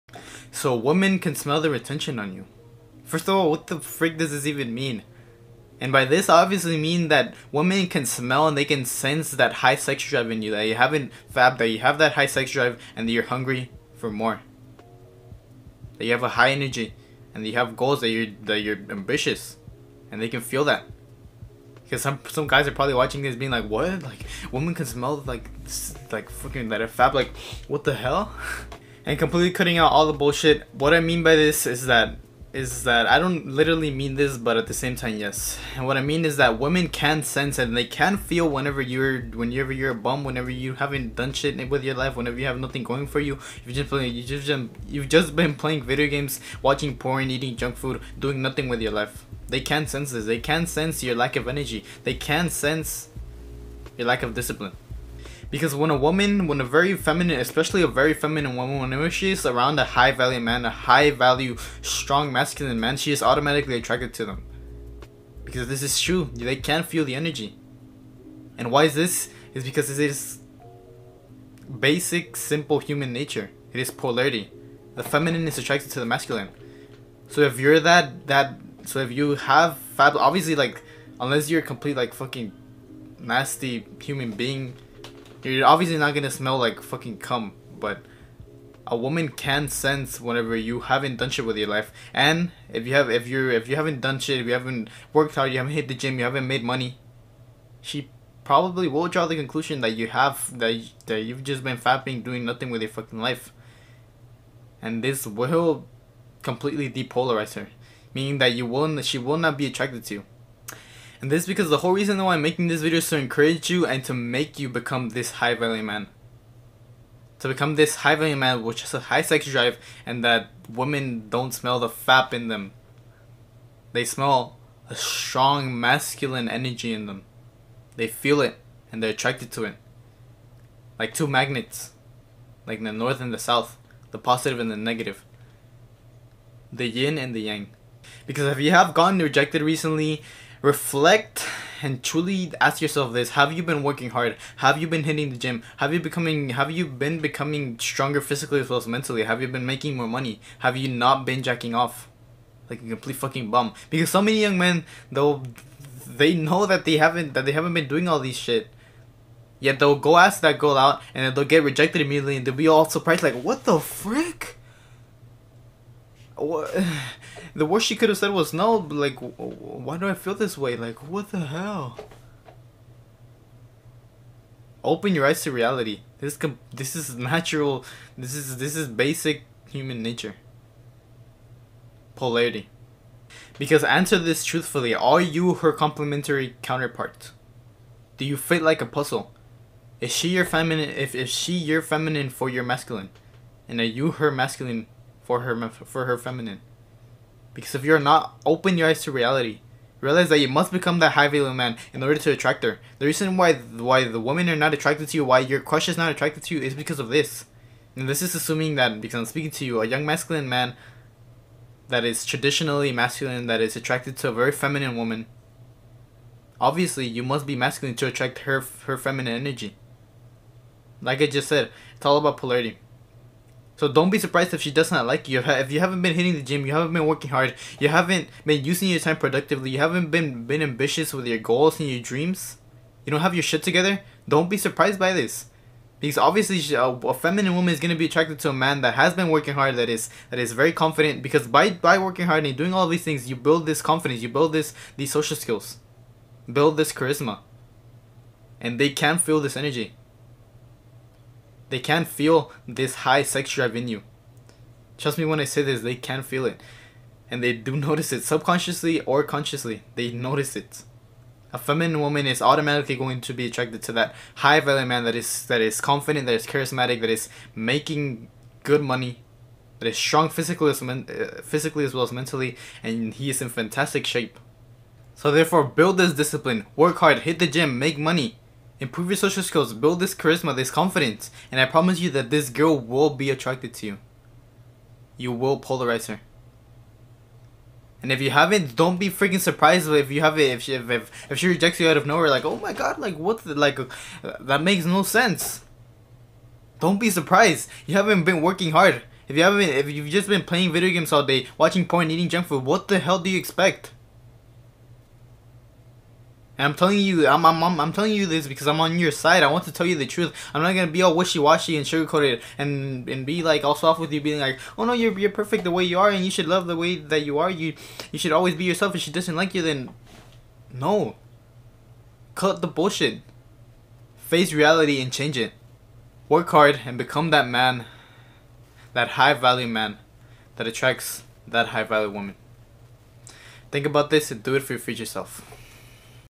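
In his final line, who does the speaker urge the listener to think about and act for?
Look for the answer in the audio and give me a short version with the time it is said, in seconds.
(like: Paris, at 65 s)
your future self, at 334 s.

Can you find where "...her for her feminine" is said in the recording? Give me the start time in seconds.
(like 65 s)
195 s.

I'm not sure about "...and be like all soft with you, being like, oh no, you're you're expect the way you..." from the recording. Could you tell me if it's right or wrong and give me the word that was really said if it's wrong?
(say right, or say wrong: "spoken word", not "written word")
wrong: "perfect", not "expect".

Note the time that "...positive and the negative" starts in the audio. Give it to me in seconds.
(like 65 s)
134 s.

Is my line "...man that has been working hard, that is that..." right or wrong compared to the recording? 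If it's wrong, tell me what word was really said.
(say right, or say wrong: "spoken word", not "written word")
right.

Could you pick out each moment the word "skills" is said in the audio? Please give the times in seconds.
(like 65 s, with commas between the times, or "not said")
245 s, 279 s.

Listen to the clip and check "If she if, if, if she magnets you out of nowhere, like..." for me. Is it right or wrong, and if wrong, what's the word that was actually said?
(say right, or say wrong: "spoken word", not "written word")
wrong: "rejects", not "magnets".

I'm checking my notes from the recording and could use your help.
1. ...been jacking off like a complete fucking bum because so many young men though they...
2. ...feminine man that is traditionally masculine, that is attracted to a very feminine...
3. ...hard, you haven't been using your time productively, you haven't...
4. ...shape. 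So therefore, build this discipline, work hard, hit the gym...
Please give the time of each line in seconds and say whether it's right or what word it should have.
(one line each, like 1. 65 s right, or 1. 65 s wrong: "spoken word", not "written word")
1. 151 s right
2. 210 s wrong: "masculine", not "feminine"
3. 227 s right
4. 274 s right.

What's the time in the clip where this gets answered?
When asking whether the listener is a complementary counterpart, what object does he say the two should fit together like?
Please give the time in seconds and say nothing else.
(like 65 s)
188 s.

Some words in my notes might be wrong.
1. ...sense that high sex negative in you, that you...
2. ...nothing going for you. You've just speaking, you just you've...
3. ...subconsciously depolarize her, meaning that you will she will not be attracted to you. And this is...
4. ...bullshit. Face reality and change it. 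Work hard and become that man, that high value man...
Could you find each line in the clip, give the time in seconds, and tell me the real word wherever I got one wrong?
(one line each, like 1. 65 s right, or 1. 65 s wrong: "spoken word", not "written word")
1. 8 s wrong: "drive", not "negative"
2. 42 s wrong: "playing", not "speaking"
3. 106 s wrong: "completely", not "subconsciously"
4. 322 s right.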